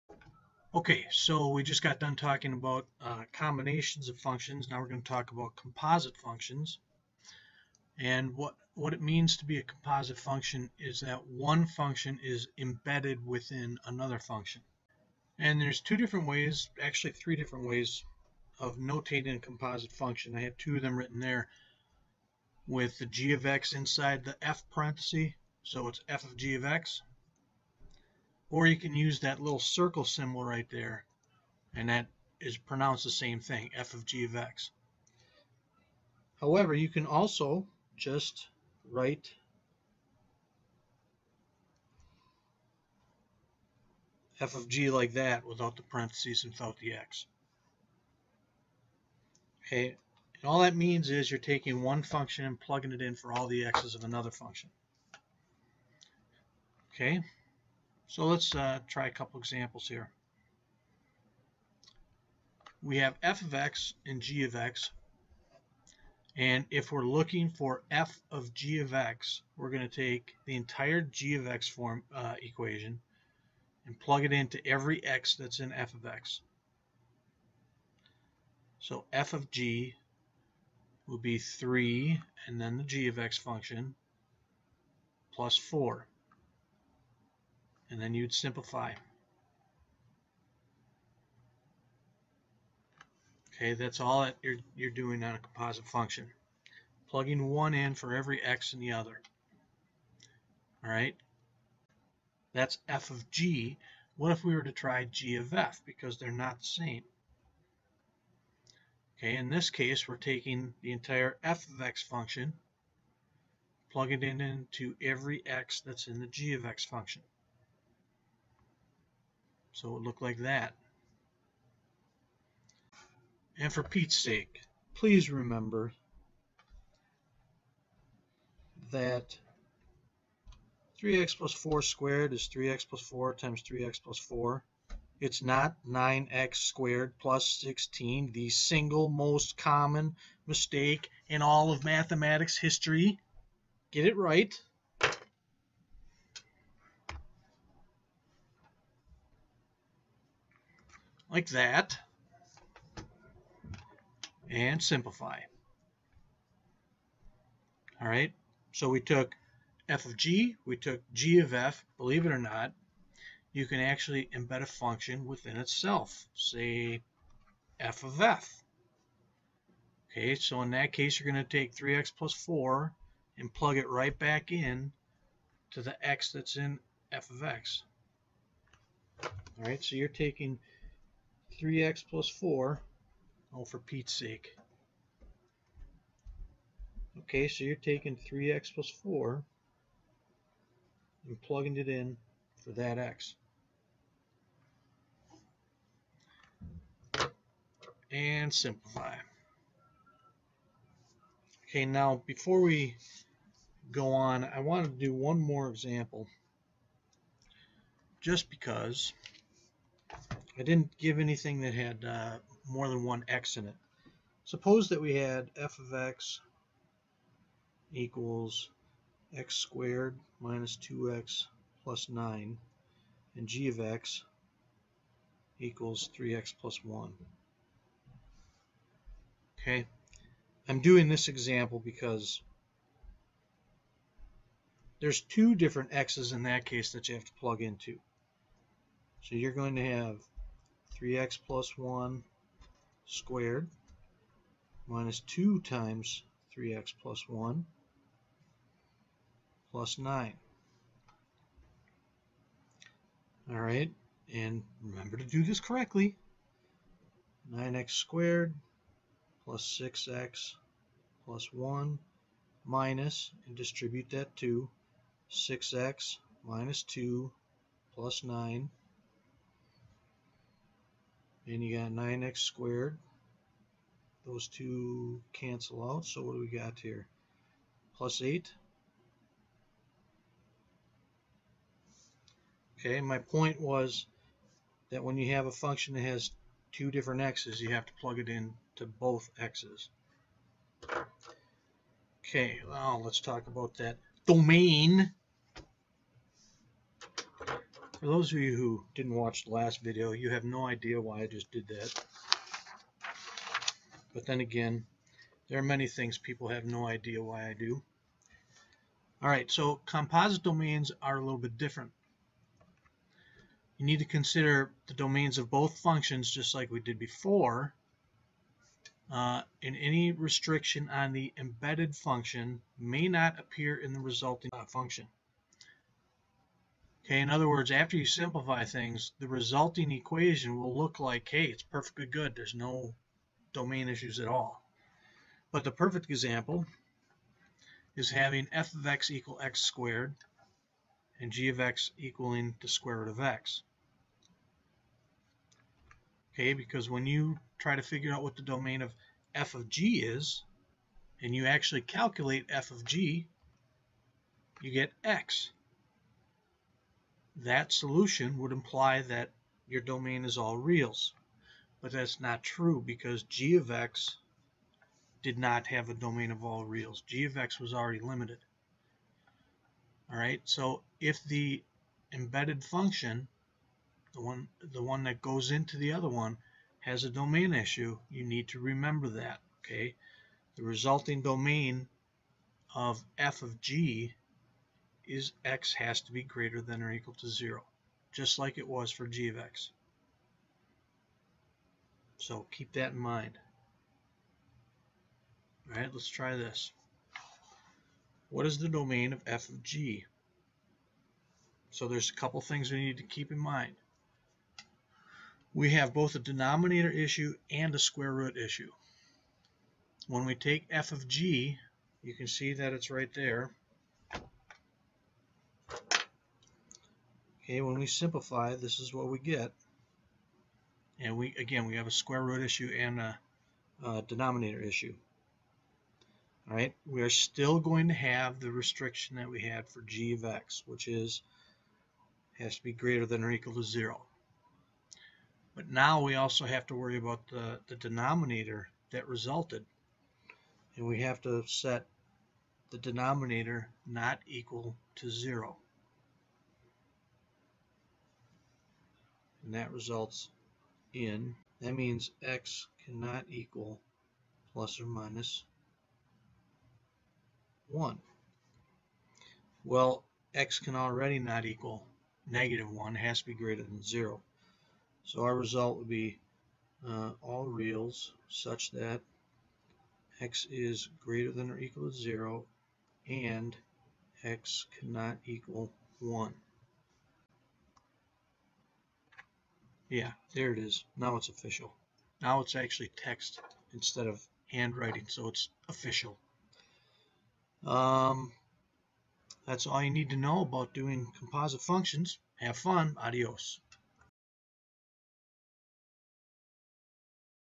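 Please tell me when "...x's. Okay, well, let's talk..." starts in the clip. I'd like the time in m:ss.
4:49.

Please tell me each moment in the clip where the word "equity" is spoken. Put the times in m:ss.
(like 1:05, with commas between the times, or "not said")
not said.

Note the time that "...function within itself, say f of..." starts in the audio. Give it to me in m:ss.
2:44.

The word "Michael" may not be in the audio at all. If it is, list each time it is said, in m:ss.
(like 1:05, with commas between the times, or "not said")
not said.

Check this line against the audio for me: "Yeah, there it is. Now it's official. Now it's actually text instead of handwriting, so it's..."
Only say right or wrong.
right.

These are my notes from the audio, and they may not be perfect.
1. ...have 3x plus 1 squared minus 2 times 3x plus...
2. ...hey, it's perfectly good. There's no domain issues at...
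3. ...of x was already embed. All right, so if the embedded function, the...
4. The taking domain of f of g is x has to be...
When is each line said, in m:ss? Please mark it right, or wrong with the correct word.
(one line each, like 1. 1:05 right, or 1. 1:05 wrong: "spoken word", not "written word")
1. 3:59 right
2. 5:31 right
3. 6:07 wrong: "limited", not "embed"
4. 6:20 wrong: "resulting", not "taking".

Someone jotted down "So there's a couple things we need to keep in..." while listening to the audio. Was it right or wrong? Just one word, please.
right.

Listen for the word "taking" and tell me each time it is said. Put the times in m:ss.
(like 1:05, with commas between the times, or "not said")
0:51, 1:50, 3:00, 3:07.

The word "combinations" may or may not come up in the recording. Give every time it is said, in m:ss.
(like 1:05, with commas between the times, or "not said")
0:03.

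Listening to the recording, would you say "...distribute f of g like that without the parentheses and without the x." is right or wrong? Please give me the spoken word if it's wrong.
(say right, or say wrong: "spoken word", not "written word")
wrong: "write", not "distribute".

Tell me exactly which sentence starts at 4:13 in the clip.
All right, and remember to do this correctly.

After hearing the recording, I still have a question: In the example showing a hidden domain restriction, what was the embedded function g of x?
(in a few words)
square root of x.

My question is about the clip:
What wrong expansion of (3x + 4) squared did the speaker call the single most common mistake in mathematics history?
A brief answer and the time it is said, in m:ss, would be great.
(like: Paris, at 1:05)
9x squared plus 16, at 2:15.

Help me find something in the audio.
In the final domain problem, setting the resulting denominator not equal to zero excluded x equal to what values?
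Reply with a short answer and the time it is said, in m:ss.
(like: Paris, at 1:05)
plus or minus 1, at 7:34.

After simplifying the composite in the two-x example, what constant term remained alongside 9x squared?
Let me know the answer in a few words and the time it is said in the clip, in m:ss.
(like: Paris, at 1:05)
8, at 4:37.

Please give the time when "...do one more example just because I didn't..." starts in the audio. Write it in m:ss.
3:24.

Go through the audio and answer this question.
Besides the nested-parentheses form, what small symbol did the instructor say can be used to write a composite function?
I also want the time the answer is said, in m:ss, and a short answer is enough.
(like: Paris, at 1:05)
little circle, at 0:29.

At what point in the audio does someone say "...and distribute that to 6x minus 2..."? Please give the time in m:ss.
4:23.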